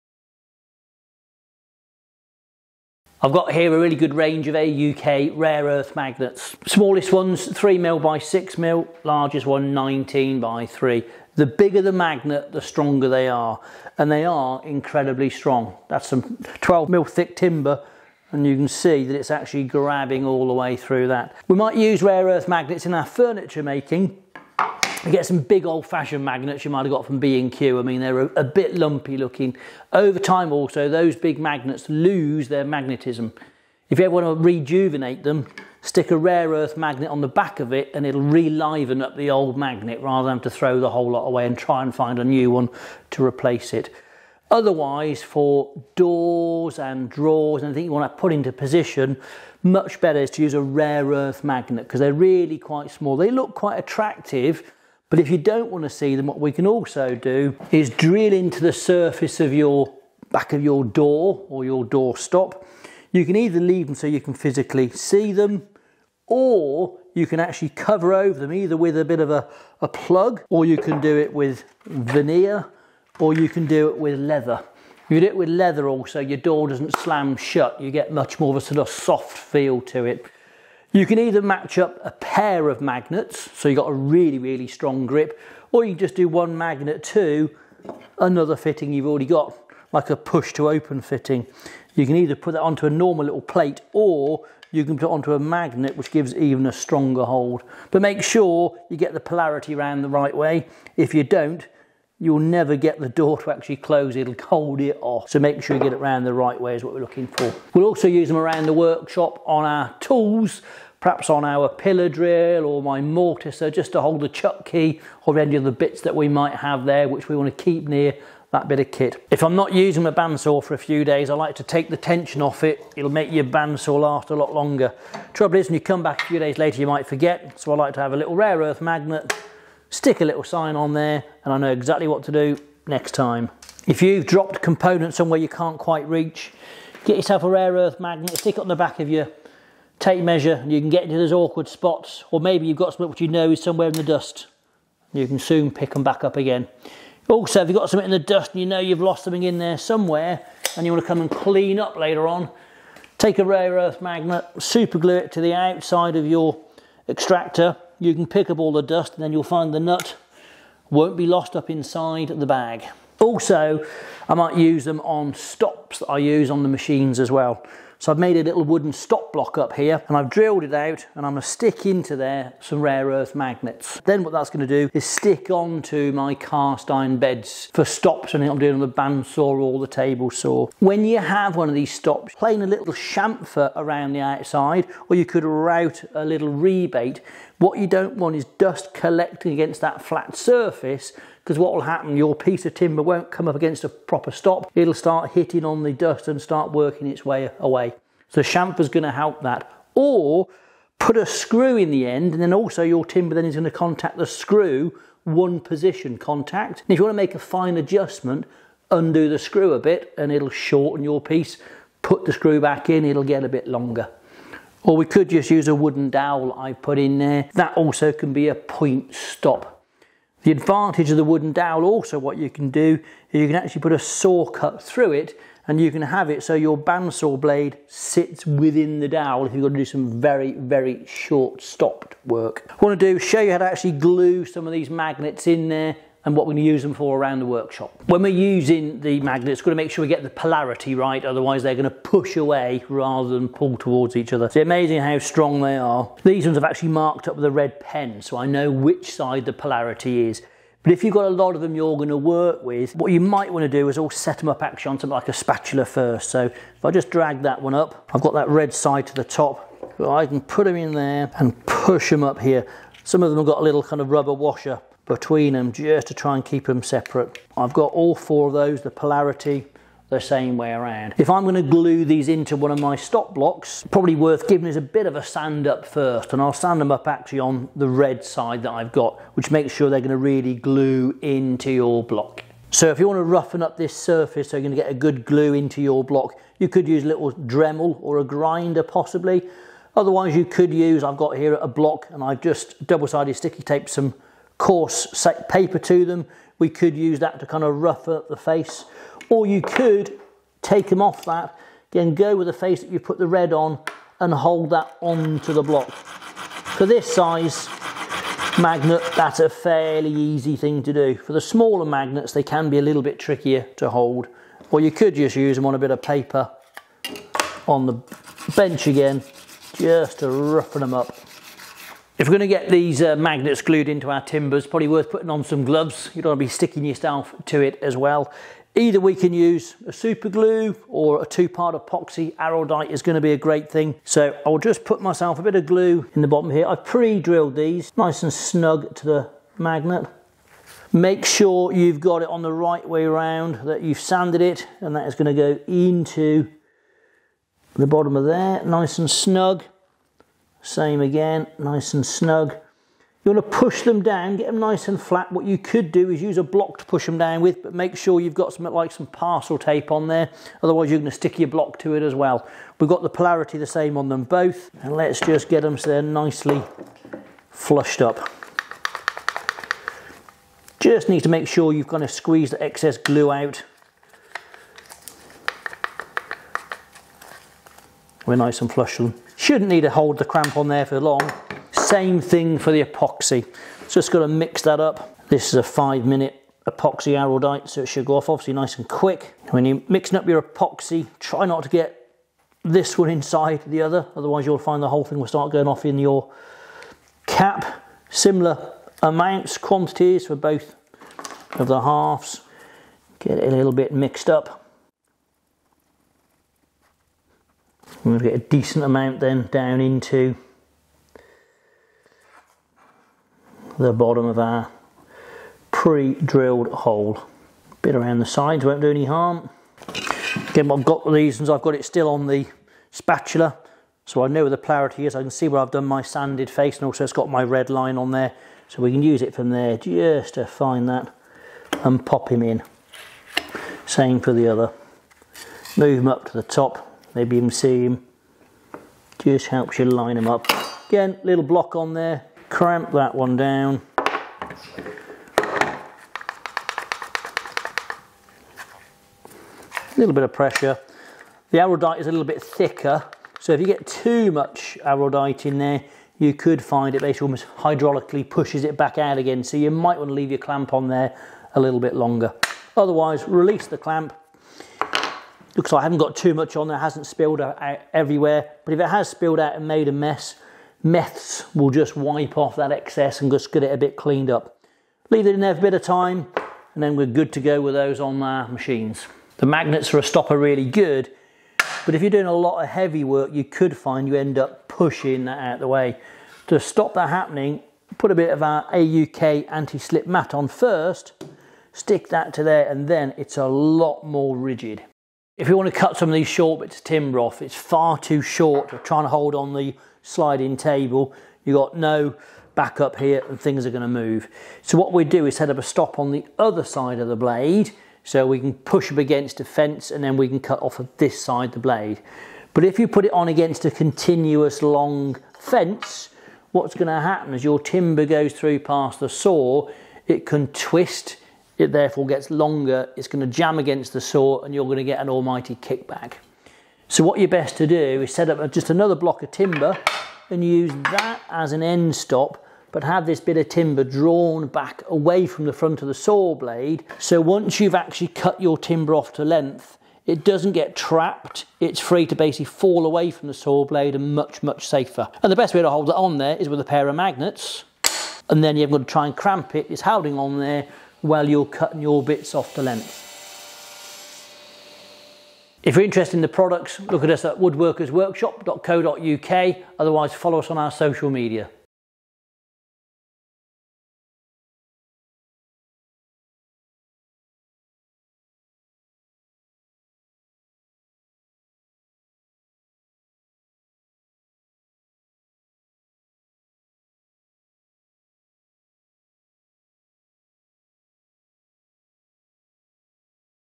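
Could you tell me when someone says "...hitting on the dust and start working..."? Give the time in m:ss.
3:15.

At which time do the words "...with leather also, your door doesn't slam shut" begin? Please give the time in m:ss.
1:15.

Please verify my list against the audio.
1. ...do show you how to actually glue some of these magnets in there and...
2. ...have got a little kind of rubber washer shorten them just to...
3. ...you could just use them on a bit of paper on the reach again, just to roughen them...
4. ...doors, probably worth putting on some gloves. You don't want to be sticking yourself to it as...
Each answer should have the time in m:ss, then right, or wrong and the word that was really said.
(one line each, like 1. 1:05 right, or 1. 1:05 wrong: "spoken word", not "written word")
1. 3:53 right
2. 4:23 wrong: "between", not "shorten"
3. 5:14 wrong: "bench", not "reach"
4. 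5:24 wrong: "timbers", not "doors".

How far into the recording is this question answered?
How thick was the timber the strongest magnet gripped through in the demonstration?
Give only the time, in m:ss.
0:16.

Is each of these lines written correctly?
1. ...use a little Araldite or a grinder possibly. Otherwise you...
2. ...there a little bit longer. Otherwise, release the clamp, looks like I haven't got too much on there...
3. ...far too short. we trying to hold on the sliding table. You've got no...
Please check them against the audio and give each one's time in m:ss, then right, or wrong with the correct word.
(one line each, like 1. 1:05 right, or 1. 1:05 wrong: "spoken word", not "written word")
1. 4:46 wrong: "Dremel", not "Araldite"
2. 7:40 right
3. 8:17 right.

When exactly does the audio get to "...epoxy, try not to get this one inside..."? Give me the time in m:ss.
6:30.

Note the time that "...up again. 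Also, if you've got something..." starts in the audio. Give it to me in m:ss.
2:26.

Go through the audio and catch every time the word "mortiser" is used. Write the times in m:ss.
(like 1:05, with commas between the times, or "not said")
1:53.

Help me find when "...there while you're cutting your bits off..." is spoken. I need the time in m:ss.
9:10.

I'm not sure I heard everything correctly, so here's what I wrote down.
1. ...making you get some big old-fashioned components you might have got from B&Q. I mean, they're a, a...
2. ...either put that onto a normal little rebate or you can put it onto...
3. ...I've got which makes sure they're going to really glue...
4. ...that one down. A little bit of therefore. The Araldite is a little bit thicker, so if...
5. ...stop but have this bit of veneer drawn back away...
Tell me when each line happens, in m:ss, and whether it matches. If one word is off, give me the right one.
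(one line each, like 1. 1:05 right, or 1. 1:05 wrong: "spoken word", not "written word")
1. 0:23 wrong: "magnets", not "components"
2. 1:32 wrong: "plate", not "rebate"
3. 4:38 right
4. 7:22 wrong: "pressure", not "therefore"
5. 8:51 wrong: "timber", not "veneer".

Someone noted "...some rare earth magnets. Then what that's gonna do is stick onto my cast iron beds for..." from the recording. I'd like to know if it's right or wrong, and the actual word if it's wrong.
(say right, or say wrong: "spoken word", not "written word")
right.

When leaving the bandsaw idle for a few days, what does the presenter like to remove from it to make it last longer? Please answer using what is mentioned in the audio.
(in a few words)
The tension.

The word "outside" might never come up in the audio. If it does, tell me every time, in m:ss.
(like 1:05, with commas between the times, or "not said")
2:35, 3:04.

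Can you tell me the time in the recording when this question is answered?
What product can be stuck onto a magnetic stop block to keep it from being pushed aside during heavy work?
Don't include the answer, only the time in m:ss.
8:08.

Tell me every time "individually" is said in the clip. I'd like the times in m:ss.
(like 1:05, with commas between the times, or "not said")
not said.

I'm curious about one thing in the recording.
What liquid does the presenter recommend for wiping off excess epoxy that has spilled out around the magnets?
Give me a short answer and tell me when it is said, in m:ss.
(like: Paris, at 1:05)
Meths, at 7:50.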